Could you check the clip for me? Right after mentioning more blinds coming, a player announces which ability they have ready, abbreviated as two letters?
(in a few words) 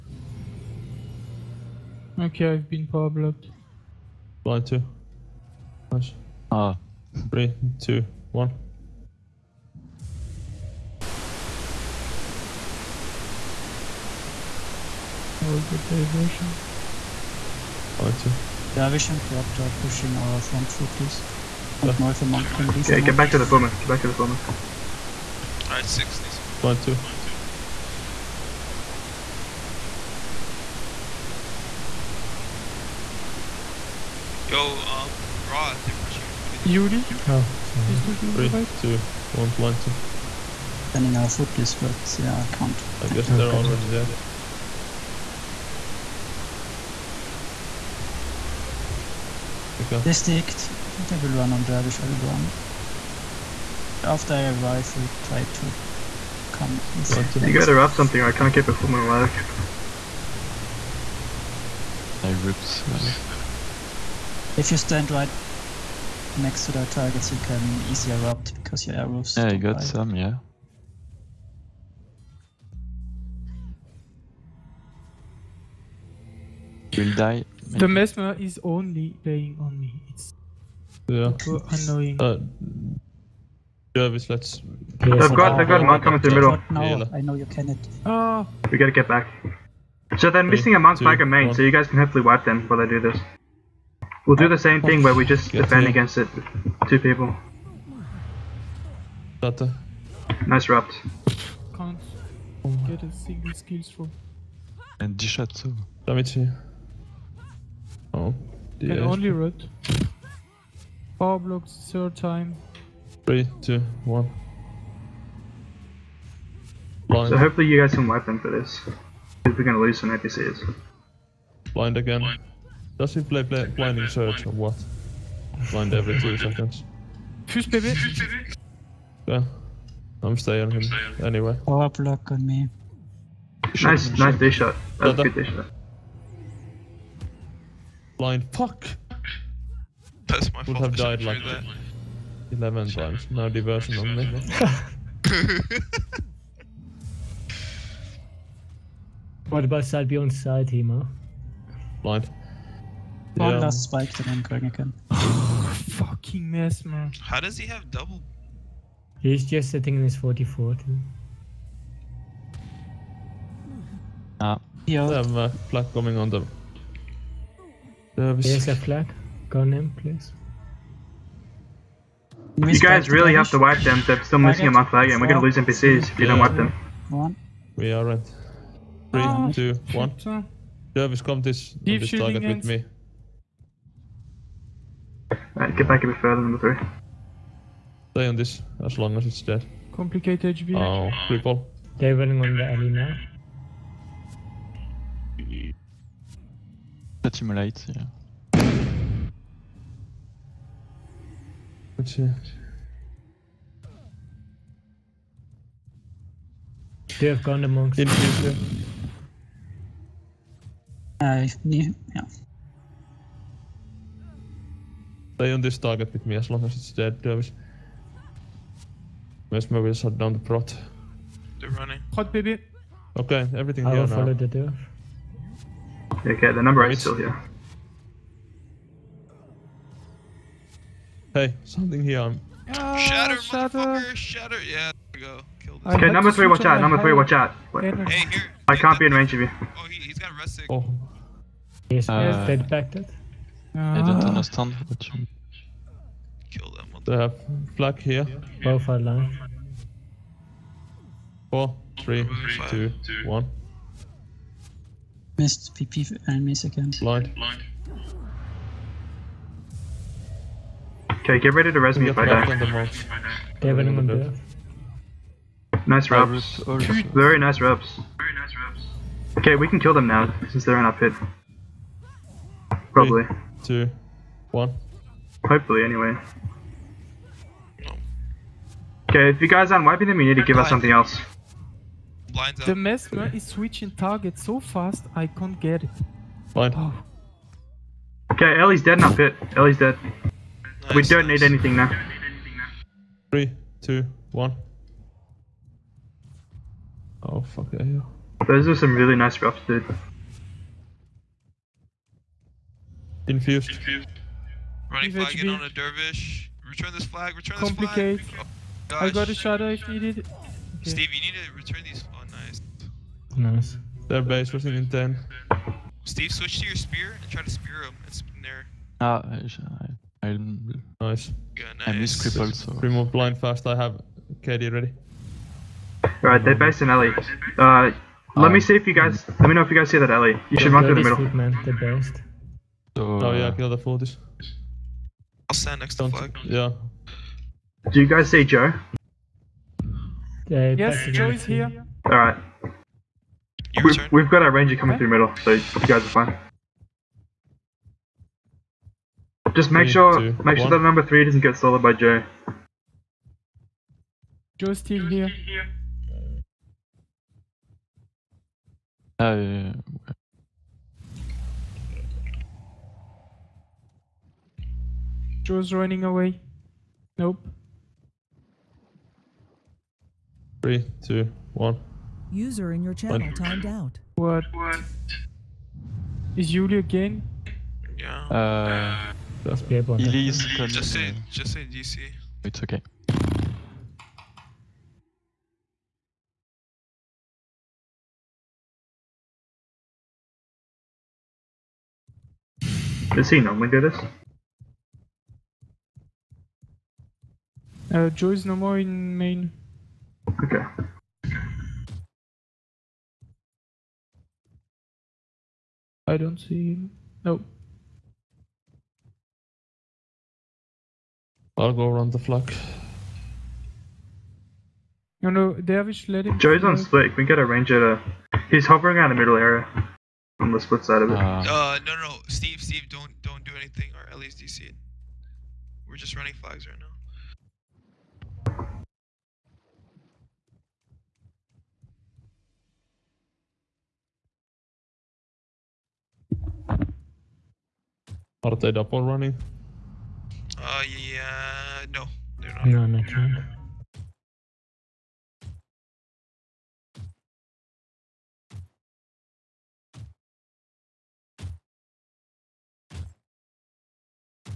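KD.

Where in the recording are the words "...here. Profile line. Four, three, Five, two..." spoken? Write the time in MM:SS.
04:07.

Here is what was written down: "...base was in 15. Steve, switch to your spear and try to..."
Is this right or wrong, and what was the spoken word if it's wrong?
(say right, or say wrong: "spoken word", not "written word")
wrong: "10", not "15".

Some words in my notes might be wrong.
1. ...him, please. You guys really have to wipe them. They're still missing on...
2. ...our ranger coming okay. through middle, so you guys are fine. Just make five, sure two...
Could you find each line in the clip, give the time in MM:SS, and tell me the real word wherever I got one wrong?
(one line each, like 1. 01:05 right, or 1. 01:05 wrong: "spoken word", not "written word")
1. 02:49 right
2. 05:44 wrong: "three", not "five".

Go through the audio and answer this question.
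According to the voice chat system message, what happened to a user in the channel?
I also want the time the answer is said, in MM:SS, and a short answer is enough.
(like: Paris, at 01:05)
timed out, at 06:13.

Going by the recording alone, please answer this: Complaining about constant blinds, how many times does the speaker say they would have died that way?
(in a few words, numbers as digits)
11.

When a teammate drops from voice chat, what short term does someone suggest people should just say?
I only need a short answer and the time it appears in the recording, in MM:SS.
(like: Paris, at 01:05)
DC, at 06:21.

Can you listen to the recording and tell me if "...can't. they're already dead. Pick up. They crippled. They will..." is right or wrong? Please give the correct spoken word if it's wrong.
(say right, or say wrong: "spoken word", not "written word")
wrong: "sticked", not "crippled".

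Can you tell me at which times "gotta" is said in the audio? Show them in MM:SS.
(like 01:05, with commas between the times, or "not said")
00:57, 01:28.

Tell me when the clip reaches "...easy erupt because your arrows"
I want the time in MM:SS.
01:07.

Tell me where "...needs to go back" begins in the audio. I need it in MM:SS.
00:26.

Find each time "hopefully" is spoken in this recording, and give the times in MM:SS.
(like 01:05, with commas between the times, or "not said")
01:31, 01:57, 04:35.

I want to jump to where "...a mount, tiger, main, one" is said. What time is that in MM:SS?
01:30.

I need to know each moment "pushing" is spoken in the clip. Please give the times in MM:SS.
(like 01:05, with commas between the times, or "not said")
00:19, 00:36.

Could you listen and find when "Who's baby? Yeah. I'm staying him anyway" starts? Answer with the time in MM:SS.
02:07.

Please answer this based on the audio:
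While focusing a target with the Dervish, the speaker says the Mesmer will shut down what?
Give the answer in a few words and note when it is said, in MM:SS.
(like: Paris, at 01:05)
the prot, at 03:40.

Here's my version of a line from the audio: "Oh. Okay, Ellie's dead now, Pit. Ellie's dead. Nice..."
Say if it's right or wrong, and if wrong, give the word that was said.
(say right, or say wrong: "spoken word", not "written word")
right.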